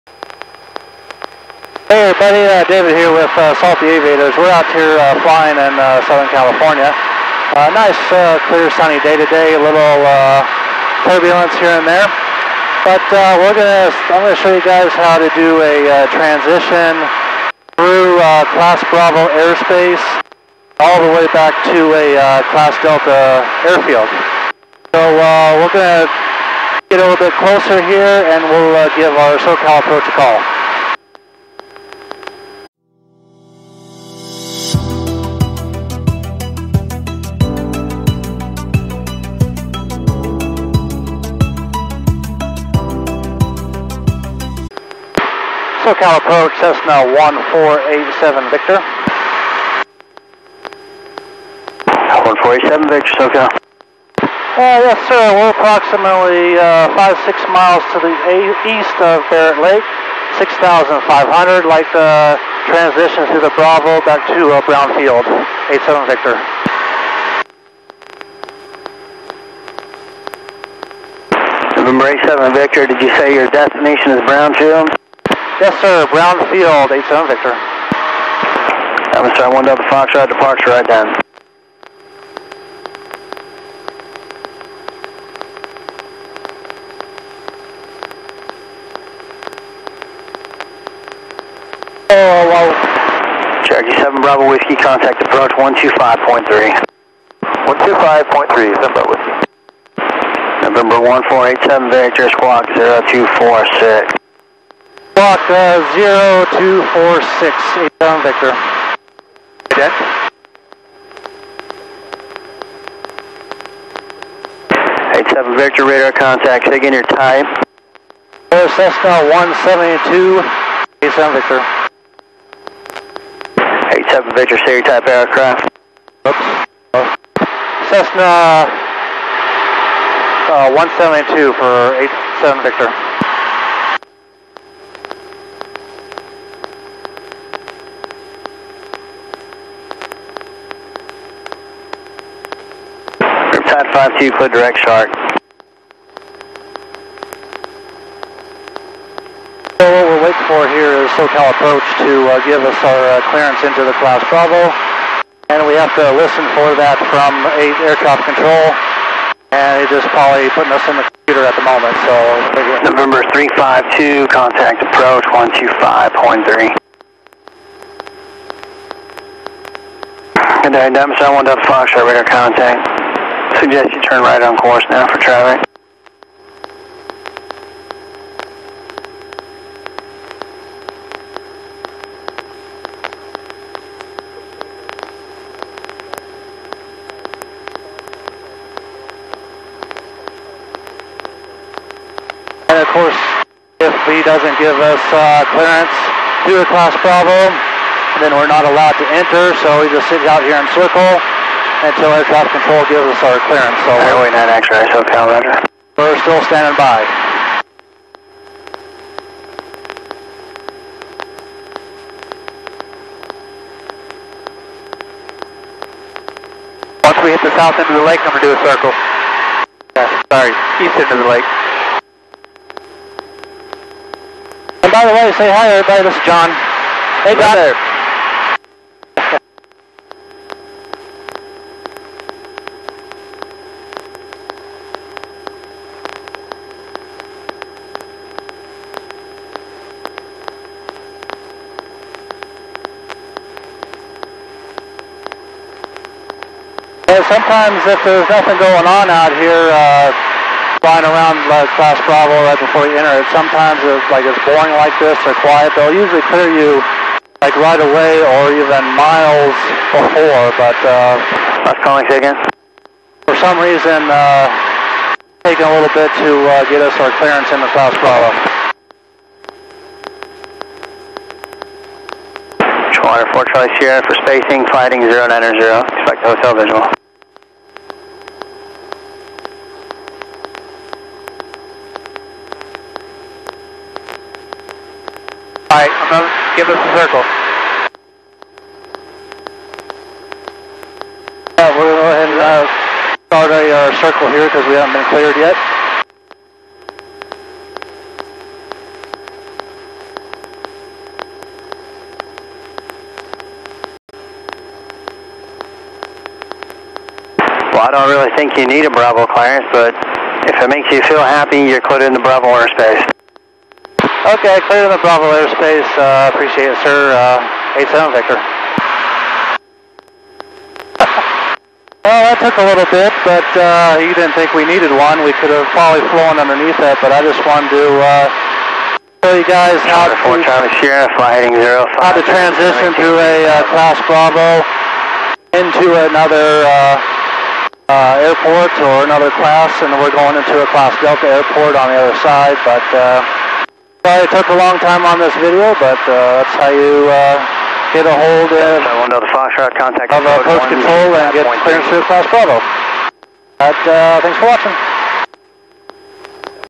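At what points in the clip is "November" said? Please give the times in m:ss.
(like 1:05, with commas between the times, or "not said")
1:40, 2:42.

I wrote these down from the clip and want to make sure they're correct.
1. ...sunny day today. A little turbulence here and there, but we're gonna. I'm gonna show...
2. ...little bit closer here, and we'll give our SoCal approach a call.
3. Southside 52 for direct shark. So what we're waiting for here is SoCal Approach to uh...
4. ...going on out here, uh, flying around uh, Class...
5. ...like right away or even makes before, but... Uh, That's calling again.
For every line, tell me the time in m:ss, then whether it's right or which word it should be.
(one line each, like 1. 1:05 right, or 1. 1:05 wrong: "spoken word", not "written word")
1. 0:08 right
2. 0:27 right
3. 2:23 right
4. 4:08 right
5. 4:17 wrong: "miles", not "makes".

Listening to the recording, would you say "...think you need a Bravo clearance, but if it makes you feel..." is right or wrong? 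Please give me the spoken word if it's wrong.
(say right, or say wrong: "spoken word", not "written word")
right.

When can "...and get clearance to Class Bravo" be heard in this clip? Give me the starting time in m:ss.
5:51.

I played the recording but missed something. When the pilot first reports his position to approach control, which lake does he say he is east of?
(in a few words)
Barrett Lake.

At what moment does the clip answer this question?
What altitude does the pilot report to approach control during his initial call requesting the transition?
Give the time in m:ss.
1:00.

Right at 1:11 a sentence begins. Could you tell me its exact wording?
Number 87 Victor, did you say your destination is Brownfield?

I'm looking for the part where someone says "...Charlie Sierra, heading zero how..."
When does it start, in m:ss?
5:30.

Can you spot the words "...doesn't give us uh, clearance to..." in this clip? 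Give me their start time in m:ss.
3:14.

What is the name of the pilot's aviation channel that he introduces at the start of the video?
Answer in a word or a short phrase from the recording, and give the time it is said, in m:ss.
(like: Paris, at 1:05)
Salty Aviators, at 0:03.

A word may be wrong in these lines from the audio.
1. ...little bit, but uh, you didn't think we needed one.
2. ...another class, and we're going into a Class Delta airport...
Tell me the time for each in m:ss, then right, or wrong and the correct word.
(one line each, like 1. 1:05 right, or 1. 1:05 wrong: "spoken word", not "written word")
1. 5:22 right
2. 5:39 right.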